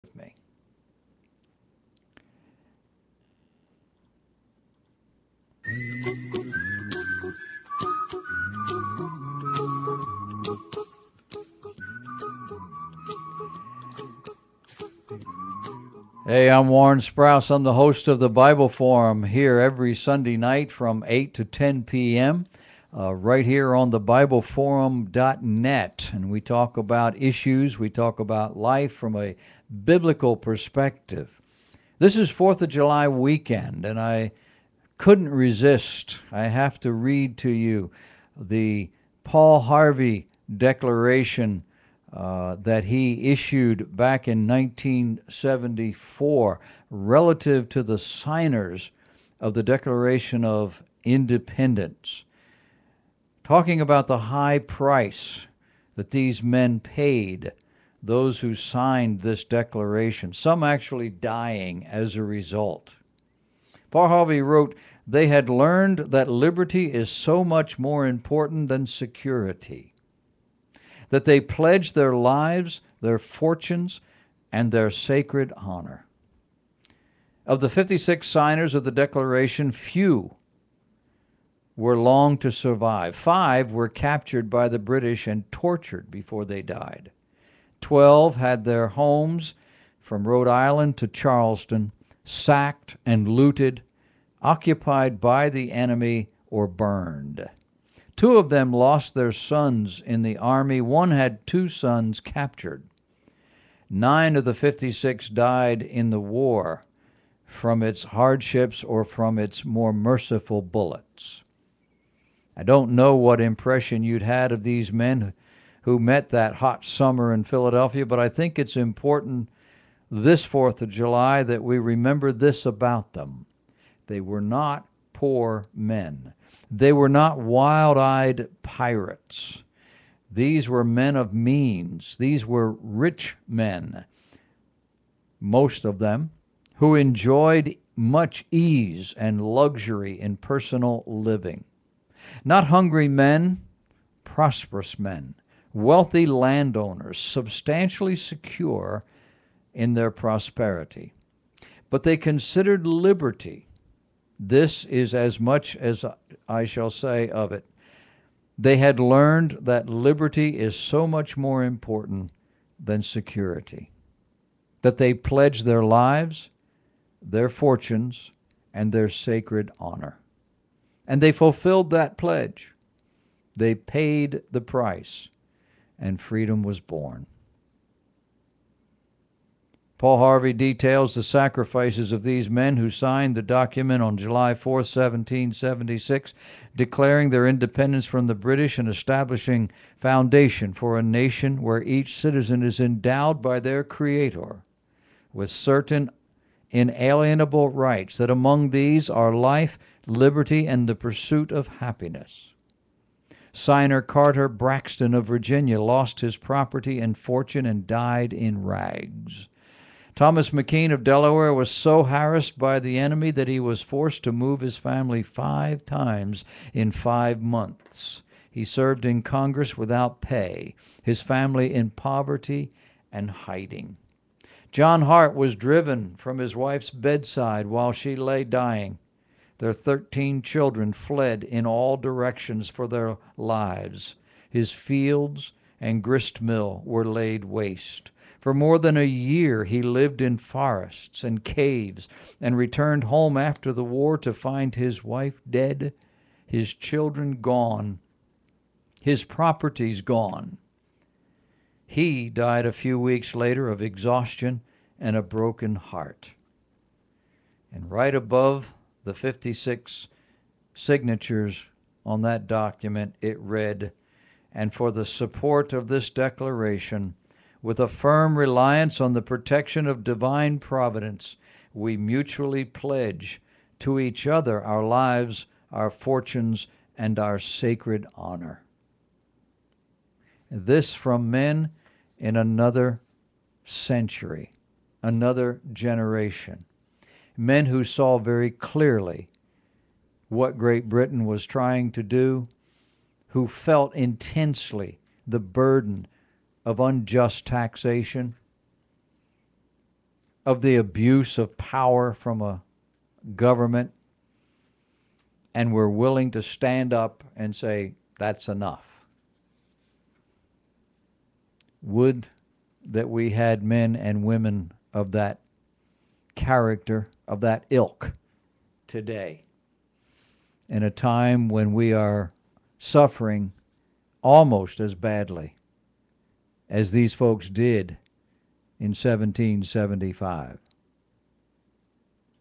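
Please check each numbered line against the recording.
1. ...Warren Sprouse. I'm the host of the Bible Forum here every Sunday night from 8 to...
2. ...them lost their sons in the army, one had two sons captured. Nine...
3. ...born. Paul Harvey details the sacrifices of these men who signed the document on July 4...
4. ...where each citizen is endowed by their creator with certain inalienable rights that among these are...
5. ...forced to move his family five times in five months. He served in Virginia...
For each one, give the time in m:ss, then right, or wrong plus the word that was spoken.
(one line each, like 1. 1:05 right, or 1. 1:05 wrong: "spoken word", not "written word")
1. 0:16 right
2. 1:38 right
3. 2:56 right
4. 3:11 right
5. 3:33 wrong: "Congress", not "Virginia".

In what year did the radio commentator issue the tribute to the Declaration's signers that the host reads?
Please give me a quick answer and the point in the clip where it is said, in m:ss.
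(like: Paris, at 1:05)
1974, at 0:44.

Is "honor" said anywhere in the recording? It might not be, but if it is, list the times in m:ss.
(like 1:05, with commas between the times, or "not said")
1:15, 2:49, 4:38.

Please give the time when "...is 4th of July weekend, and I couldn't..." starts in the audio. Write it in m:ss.
0:32.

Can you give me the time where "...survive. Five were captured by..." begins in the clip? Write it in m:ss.
1:22.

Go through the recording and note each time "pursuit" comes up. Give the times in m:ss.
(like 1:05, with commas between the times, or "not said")
3:20.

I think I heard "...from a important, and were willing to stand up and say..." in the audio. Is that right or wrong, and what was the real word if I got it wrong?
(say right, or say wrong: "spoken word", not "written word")
wrong: "government", not "important".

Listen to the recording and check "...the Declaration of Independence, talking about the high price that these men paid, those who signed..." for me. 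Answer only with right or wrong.
right.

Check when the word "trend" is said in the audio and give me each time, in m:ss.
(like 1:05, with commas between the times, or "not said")
not said.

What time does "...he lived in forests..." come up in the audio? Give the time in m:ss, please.
3:59.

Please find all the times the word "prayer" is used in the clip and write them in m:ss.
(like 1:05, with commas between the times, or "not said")
not said.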